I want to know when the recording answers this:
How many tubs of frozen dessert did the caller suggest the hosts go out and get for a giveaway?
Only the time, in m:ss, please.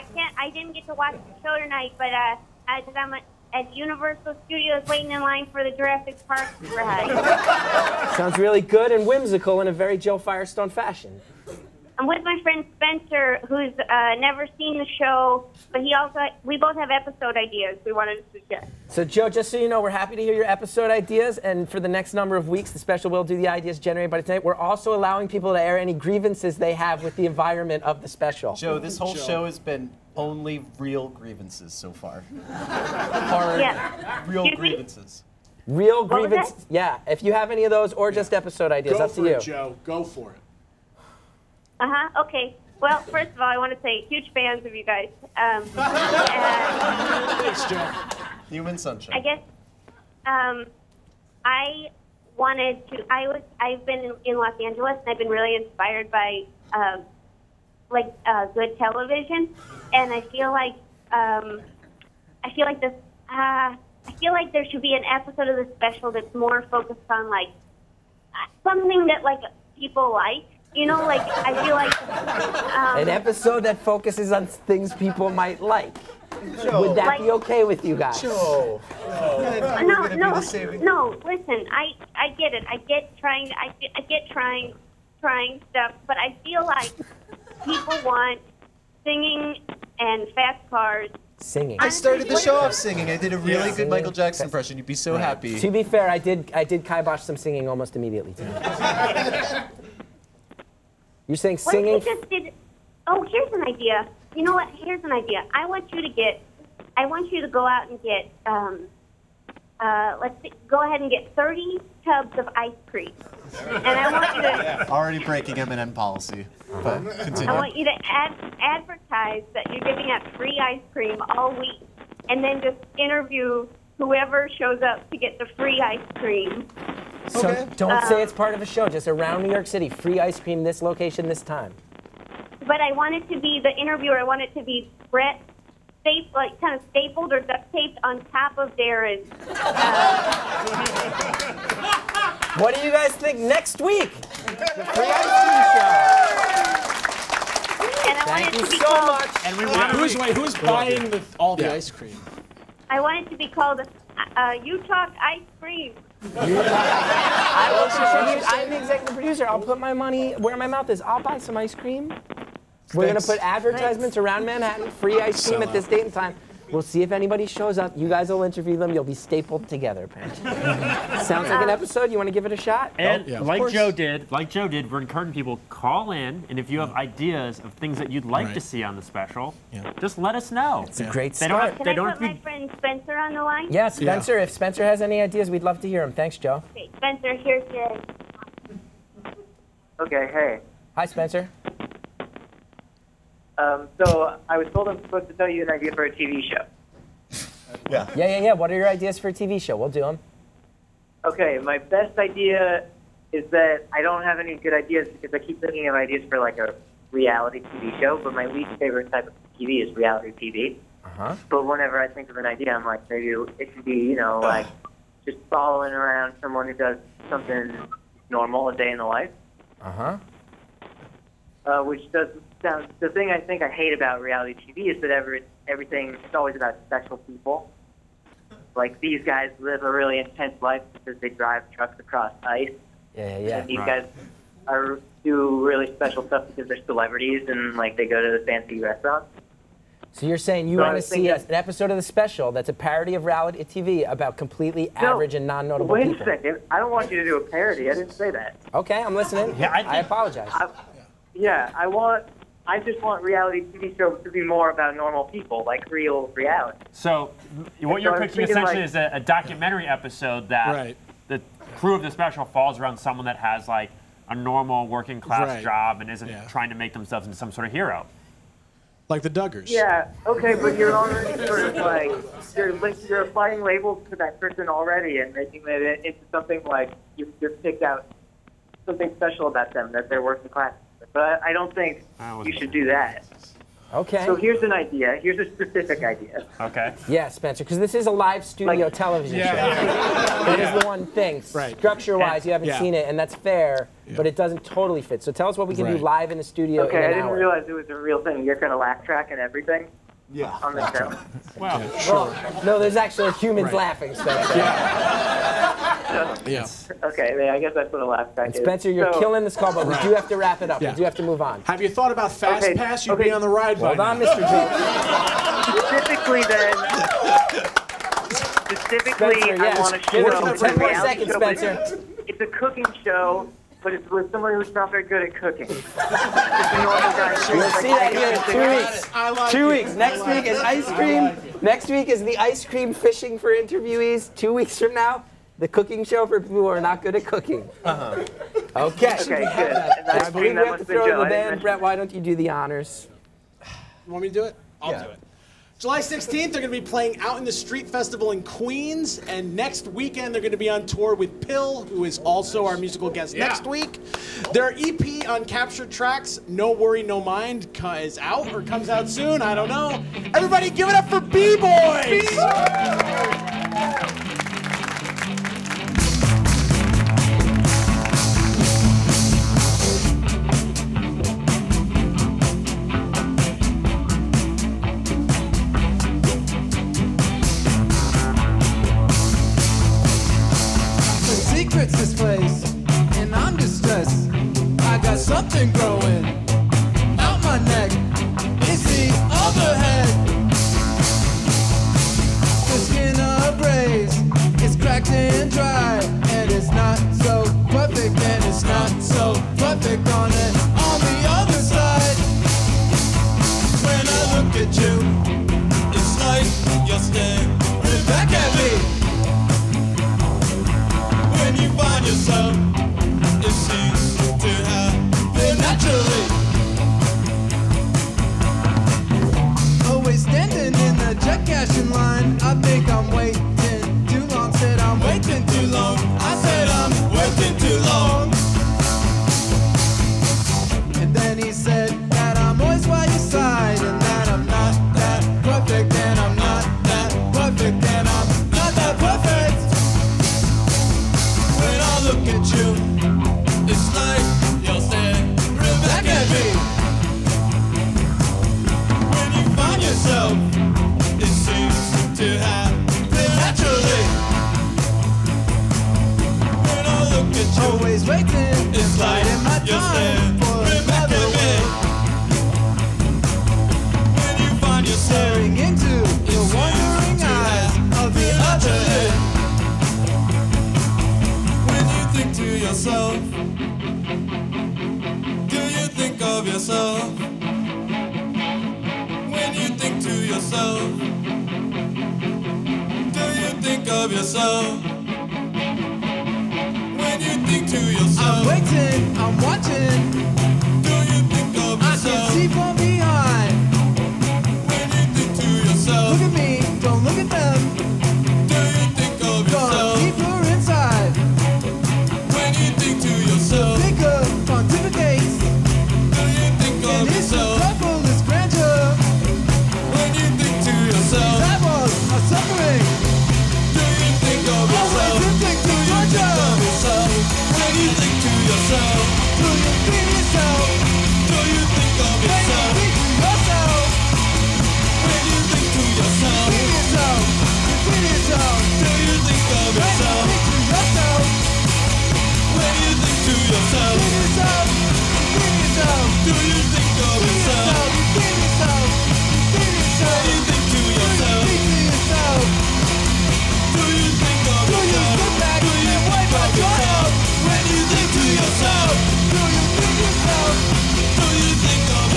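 1:51.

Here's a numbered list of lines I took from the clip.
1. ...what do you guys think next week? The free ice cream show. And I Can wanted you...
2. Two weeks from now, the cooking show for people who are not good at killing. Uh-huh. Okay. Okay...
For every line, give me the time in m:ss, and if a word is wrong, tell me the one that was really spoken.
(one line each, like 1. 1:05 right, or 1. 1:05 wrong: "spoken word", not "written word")
1. 2:22 wrong: "Thank", not "Can"
2. 5:34 wrong: "cooking", not "killing".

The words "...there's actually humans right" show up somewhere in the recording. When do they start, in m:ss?
5:02.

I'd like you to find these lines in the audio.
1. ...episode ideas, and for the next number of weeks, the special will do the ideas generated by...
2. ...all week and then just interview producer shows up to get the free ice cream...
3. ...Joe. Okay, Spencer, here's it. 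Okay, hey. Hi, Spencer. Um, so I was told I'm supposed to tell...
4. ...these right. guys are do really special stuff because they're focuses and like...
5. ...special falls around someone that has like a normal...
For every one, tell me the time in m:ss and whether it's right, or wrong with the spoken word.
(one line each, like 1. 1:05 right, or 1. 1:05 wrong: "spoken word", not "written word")
1. 0:20 right
2. 2:01 wrong: "whoever", not "producer"
3. 3:06 right
4. 3:53 wrong: "celebrities", not "focuses"
5. 4:22 right.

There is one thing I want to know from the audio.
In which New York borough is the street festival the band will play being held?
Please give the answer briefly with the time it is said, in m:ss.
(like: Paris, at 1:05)
Queens, at 5:48.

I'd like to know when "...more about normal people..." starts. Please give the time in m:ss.
4:14.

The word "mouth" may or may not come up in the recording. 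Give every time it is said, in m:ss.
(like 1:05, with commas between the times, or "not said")
2:40.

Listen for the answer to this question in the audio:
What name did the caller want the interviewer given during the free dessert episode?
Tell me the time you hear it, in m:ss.
2:34.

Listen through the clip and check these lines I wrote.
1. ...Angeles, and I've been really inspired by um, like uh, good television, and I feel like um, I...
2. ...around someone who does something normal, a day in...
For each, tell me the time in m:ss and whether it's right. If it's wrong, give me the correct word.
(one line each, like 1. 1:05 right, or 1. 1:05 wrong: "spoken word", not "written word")
1. 0:54 right
2. 3:35 right.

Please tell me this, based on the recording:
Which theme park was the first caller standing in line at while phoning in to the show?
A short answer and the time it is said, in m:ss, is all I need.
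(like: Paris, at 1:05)
Universal Studios, at 0:03.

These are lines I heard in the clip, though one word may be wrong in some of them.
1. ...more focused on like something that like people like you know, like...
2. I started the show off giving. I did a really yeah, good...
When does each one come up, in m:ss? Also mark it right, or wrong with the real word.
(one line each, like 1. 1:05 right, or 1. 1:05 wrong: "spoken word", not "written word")
1. 1:06 right
2. 1:31 wrong: "singing", not "giving".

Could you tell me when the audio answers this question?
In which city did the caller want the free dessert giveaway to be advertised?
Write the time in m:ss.
2:09.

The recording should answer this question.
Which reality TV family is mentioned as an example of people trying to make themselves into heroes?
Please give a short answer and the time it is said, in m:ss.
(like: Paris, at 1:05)
the Duggars, at 4:29.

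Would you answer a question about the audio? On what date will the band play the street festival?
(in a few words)
July 16th.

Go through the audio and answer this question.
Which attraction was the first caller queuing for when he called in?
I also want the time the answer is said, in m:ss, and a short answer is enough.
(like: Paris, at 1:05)
Jurassic Park ride, at 0:05.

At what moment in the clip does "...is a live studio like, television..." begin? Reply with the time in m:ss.
4:47.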